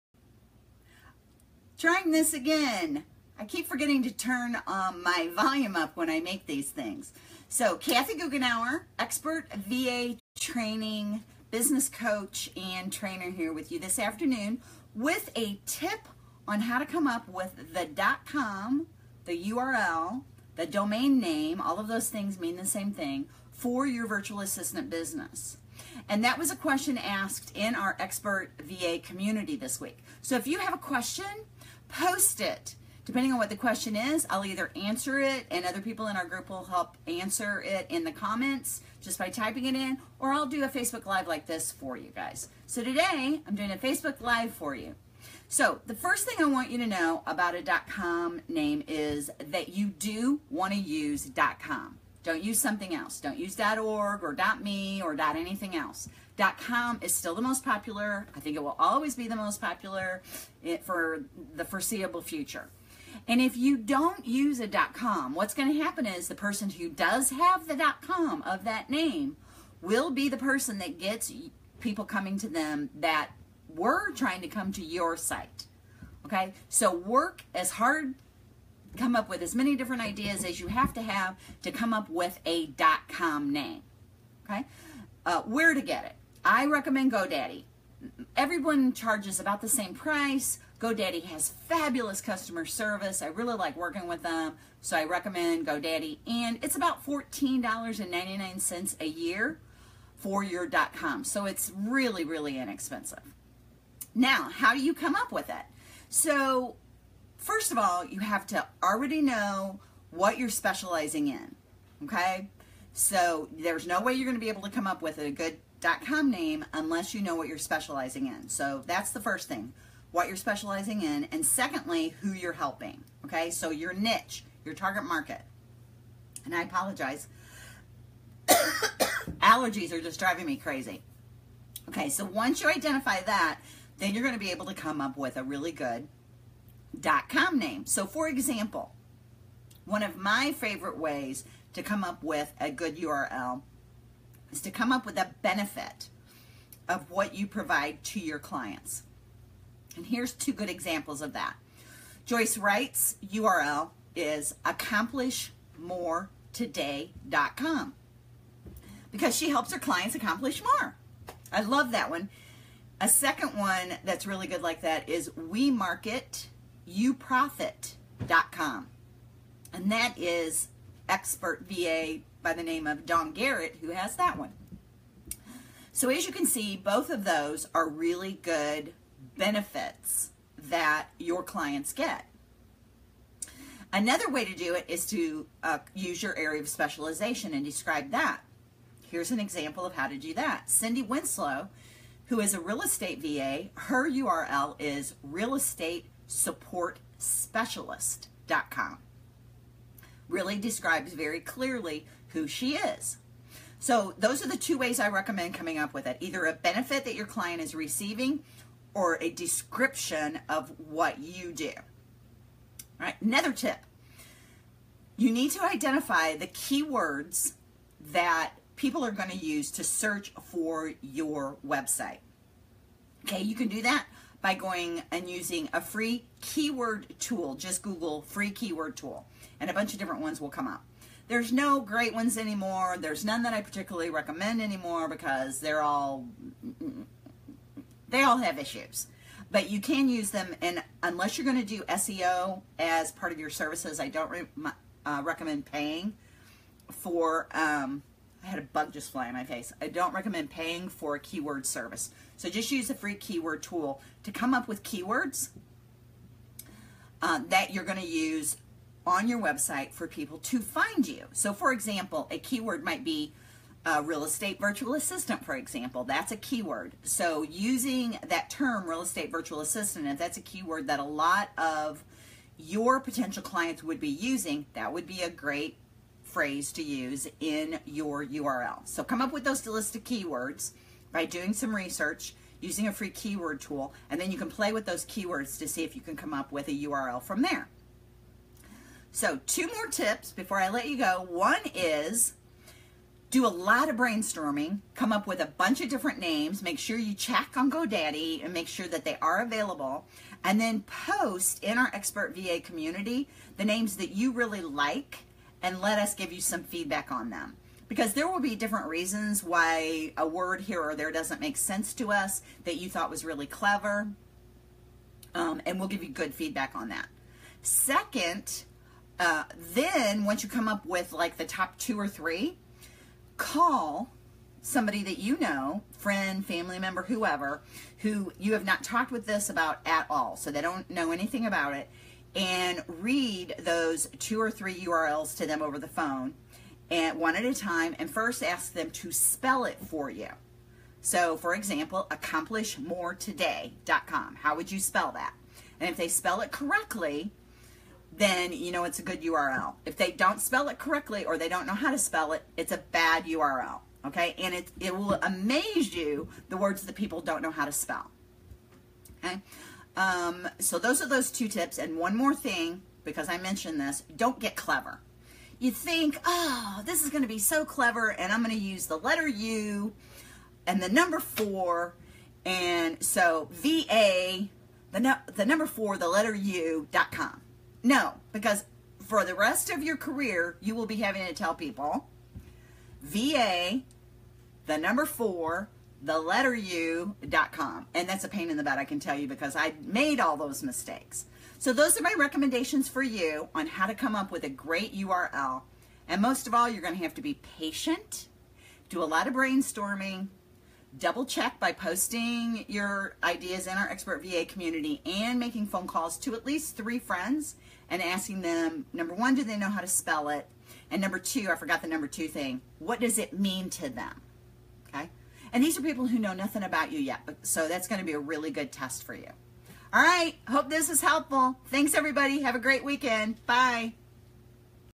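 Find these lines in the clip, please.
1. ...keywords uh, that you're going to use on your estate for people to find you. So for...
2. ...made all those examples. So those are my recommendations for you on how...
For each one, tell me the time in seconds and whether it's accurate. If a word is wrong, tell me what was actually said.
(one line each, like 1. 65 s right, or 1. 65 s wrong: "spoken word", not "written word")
1. 254 s wrong: "website", not "estate"
2. 389 s wrong: "mistakes", not "examples".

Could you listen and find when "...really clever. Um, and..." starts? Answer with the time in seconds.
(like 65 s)
313 s.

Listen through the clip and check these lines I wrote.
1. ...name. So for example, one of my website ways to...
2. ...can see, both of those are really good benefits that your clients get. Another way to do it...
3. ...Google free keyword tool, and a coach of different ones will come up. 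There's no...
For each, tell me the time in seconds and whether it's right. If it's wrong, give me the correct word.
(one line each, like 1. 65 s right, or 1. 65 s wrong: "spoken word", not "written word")
1. 137 s wrong: "favorite", not "website"
2. 176 s right
3. 227 s wrong: "bunch", not "coach".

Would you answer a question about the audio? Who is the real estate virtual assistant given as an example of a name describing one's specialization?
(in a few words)
Cindy Winslow.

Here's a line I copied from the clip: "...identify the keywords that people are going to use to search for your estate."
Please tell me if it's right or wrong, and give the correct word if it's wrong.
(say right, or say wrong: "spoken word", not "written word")
wrong: "website", not "estate".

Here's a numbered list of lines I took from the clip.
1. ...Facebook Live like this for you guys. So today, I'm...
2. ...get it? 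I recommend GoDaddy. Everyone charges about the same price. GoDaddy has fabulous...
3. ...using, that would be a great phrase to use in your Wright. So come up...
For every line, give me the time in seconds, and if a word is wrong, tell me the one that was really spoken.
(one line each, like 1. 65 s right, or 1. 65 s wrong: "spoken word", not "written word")
1. 40 s right
2. 85 s right
3. 274 s wrong: "URL", not "Wright".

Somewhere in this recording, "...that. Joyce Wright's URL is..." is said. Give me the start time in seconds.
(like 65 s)
151 s.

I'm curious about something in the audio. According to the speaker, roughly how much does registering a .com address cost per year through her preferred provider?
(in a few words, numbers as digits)
$14.99.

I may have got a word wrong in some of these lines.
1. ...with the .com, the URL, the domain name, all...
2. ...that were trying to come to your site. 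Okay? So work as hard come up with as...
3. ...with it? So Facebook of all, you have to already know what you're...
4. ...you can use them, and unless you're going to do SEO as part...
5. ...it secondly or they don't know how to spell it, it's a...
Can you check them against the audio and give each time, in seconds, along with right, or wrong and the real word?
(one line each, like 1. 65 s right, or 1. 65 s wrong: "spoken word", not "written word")
1. 17 s right
2. 72 s right
3. 105 s wrong: "First", not "Facebook"
4. 239 s right
5. 350 s wrong: "correctly", not "secondly".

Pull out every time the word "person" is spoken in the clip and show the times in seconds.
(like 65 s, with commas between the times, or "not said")
66 s, 70 s.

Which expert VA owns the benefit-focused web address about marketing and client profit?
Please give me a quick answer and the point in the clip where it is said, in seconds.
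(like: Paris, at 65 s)
Don Garrett, at 173 s.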